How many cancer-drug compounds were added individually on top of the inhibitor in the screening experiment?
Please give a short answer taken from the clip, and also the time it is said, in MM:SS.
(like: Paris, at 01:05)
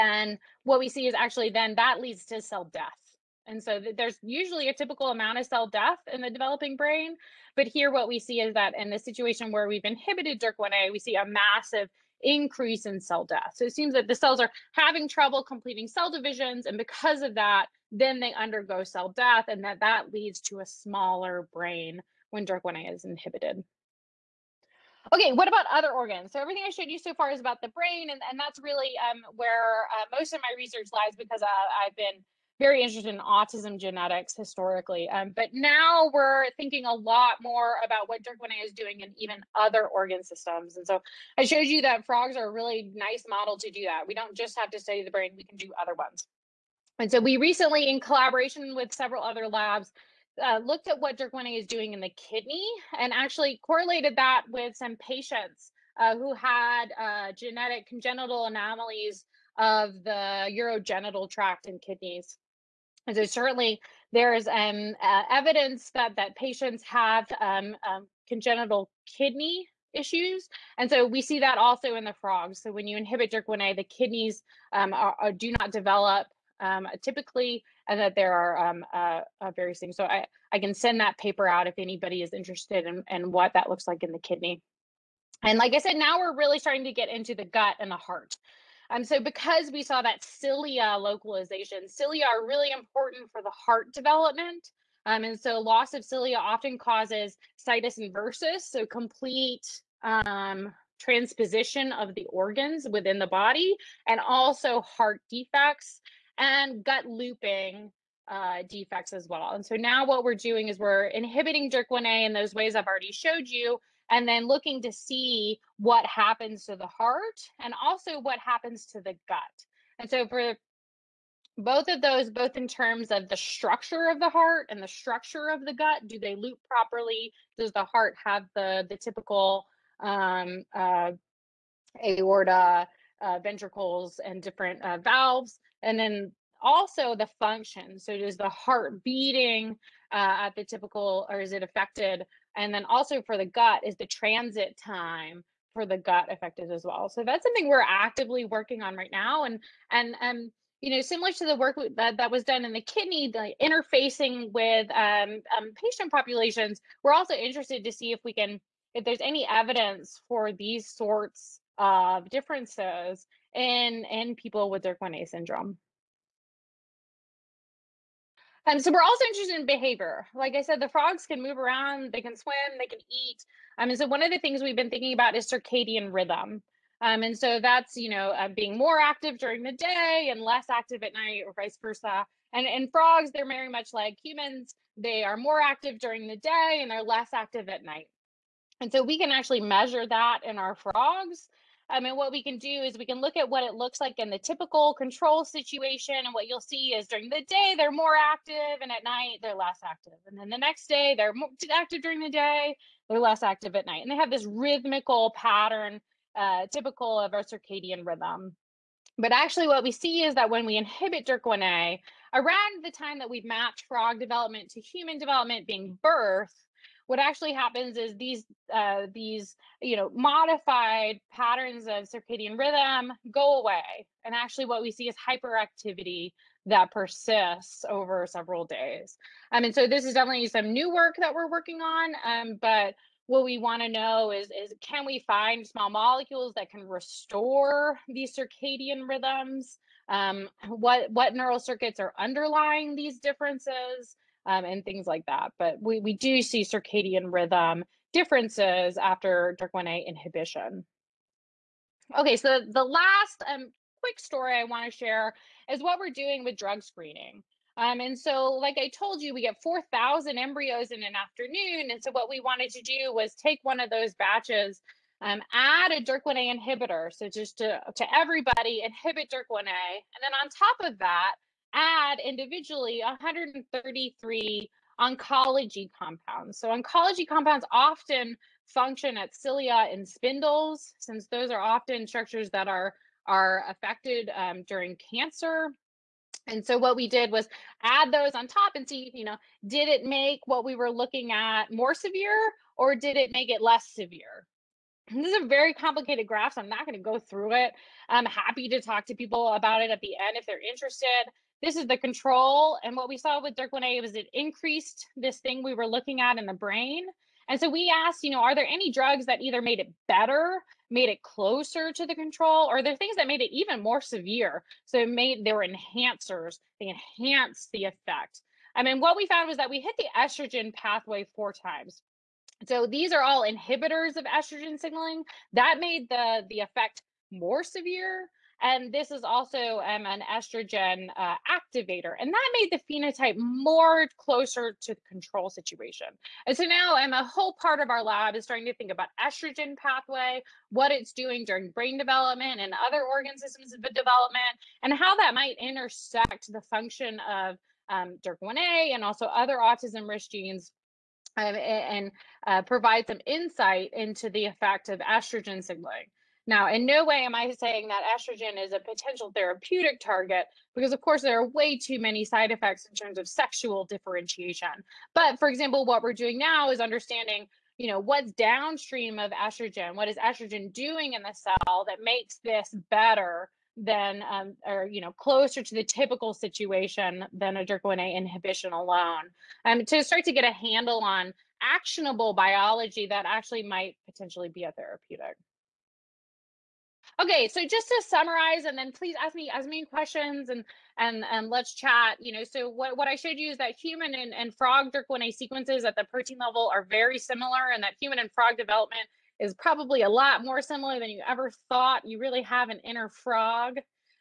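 133, at 04:33.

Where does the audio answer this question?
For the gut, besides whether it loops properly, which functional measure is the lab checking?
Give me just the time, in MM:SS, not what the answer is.
02:24.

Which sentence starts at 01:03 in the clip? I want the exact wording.
And so certainly there is um, uh, evidence that, that patients have um, um, congenital kidney issues.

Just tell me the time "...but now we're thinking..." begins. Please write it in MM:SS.
00:35.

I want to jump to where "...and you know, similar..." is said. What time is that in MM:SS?
02:30.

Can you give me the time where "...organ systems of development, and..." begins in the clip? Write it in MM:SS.
05:43.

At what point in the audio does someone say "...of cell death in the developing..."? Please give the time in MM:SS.
00:05.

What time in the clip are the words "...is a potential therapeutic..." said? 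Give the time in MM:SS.
05:58.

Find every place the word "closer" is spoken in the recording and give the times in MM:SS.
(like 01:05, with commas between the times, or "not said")
05:11, 05:34, 06:15.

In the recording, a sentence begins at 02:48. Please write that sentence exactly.
Um, so we're also interested in behavior.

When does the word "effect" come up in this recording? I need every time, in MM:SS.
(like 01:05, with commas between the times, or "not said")
05:17, 05:26, 05:54, 06:02.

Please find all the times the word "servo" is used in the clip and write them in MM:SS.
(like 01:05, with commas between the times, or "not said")
not said.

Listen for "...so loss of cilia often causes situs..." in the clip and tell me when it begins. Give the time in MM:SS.
01:35.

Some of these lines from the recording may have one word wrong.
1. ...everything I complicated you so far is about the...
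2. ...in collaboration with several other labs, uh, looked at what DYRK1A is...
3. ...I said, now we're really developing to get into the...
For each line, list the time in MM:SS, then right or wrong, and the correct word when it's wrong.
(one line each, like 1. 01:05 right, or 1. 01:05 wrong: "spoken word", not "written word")
1. 00:26 wrong: "showed", not "complicated"
2. 00:47 right
3. 01:25 wrong: "starting", not "developing".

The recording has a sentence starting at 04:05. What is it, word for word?
But we, we do see circadian rhythm differences after DYRK1A inhibition.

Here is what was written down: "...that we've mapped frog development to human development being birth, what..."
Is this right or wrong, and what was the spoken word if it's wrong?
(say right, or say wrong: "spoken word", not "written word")
right.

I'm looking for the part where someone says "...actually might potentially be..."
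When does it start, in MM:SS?
06:23.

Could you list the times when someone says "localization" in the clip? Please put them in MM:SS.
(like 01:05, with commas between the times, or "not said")
01:30.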